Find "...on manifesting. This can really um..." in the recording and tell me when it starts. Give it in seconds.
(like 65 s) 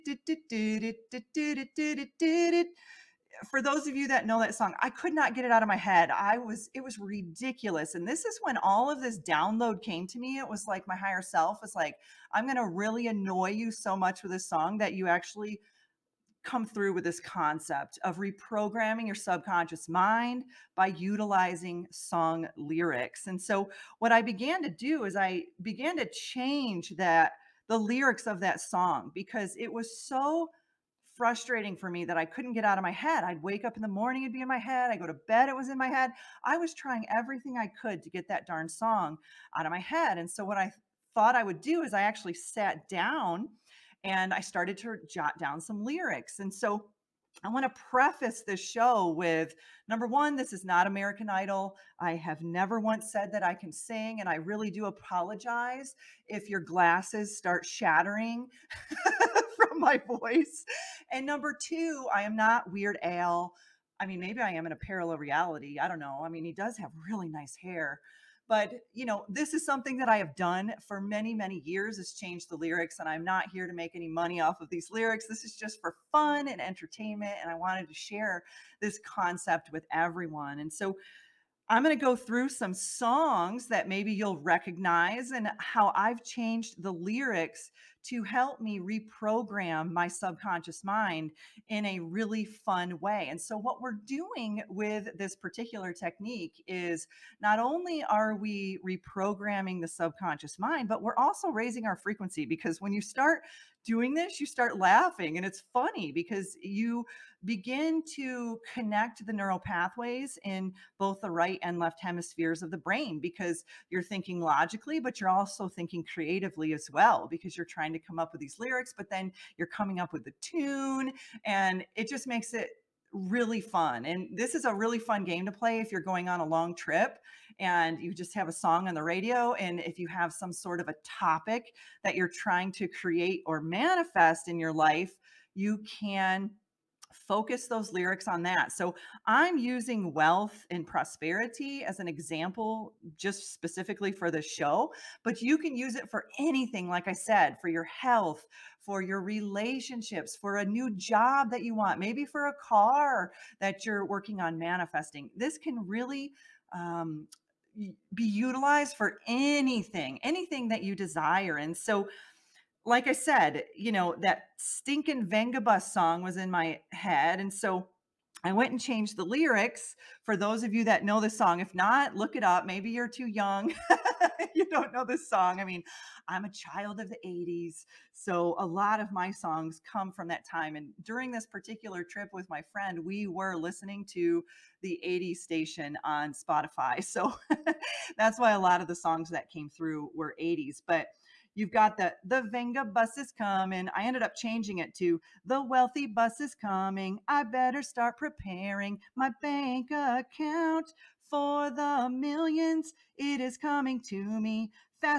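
154 s.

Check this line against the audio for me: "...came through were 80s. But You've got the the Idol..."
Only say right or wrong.
wrong.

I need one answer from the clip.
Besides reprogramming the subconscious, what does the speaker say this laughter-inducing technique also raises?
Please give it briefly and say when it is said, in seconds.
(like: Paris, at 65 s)
frequency, at 101 s.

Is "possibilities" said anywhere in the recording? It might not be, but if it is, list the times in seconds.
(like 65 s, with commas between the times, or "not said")
not said.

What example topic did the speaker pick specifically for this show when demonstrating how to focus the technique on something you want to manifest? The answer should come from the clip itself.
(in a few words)
wealth and prosperity.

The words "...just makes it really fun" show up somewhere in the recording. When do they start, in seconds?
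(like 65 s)
122 s.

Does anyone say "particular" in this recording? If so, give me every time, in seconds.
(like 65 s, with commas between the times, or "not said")
95 s, 181 s.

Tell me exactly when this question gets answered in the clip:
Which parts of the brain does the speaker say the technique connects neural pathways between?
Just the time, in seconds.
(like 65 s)
111 s.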